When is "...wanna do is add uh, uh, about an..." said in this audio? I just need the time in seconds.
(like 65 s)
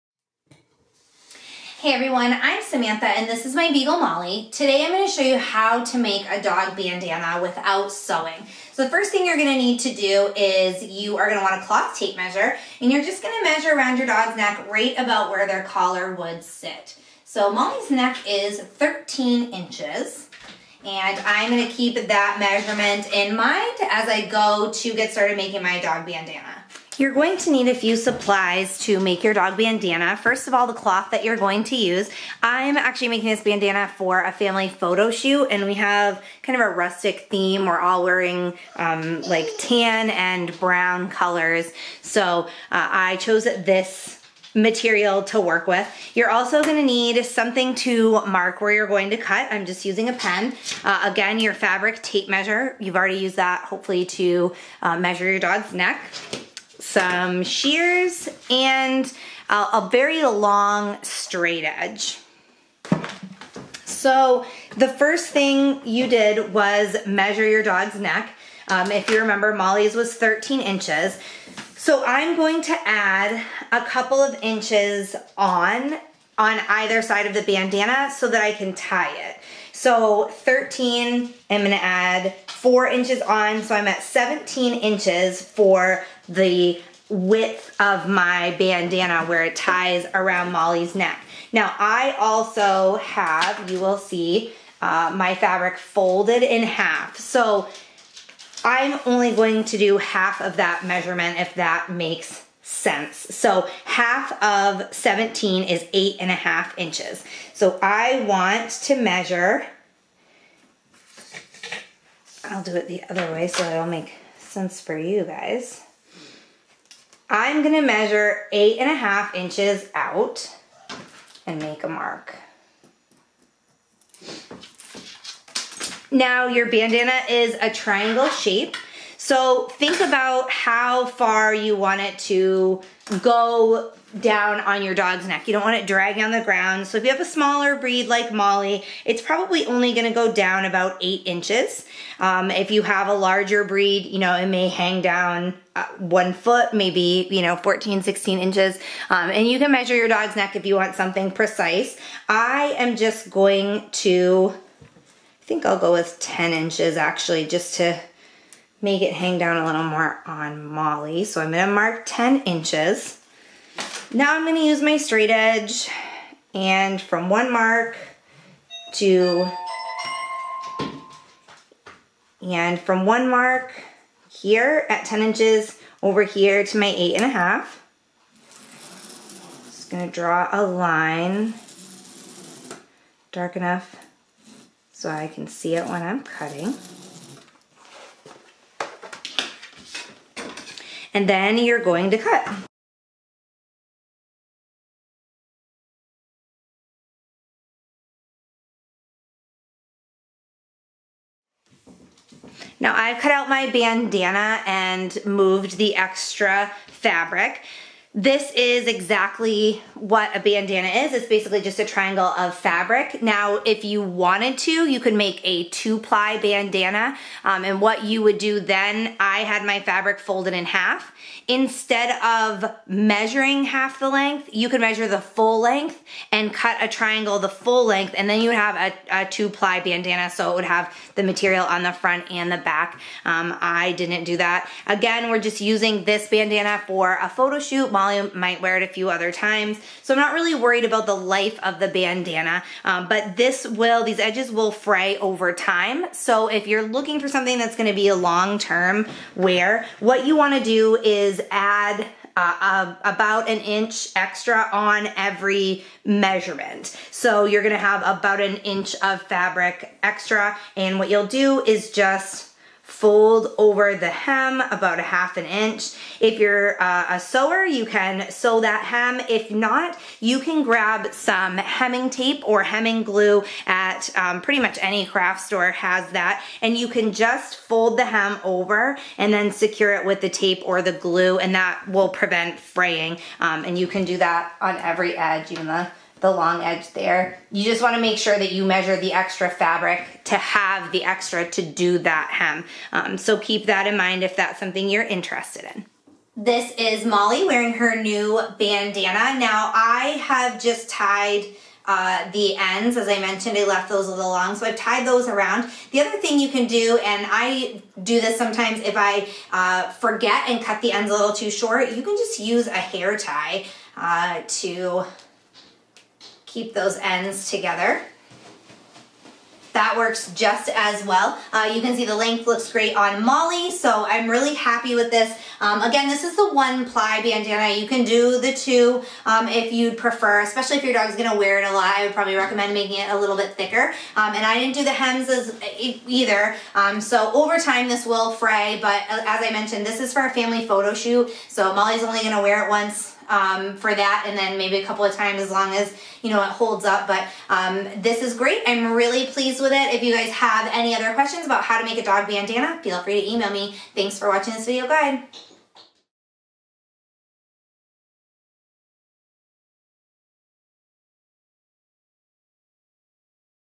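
250 s.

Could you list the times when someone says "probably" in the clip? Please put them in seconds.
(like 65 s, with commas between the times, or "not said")
139 s, 332 s.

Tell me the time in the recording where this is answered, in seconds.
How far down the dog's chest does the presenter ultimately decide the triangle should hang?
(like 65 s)
156 s.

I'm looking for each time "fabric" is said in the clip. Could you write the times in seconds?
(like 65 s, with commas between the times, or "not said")
51 s, 95 s, 206 s, 212 s, 219 s, 259 s, 289 s.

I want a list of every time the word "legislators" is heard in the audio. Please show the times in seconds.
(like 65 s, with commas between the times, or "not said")
not said.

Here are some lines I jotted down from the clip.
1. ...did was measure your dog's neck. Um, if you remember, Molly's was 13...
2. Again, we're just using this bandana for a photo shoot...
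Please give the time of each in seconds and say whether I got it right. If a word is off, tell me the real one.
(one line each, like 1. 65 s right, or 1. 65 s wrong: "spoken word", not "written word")
1. 66 s right
2. 234 s right.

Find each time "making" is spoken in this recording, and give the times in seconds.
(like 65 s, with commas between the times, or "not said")
25 s, 33 s, 332 s.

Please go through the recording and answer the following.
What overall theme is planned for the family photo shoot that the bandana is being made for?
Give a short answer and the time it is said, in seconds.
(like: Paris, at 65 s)
rustic, at 36 s.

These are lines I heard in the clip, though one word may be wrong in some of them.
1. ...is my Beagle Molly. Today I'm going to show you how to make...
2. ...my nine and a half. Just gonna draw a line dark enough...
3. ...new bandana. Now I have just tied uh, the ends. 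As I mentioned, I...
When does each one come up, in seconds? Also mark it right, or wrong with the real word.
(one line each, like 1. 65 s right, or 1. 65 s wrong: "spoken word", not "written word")
1. 3 s right
2. 176 s wrong: "eight", not "nine"
3. 298 s right.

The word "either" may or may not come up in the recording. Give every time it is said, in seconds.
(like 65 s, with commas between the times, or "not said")
76 s, 336 s.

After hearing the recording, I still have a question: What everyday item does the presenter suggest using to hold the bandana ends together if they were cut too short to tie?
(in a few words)
hair tie.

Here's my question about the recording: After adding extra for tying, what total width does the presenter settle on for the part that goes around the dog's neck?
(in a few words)
17 inches.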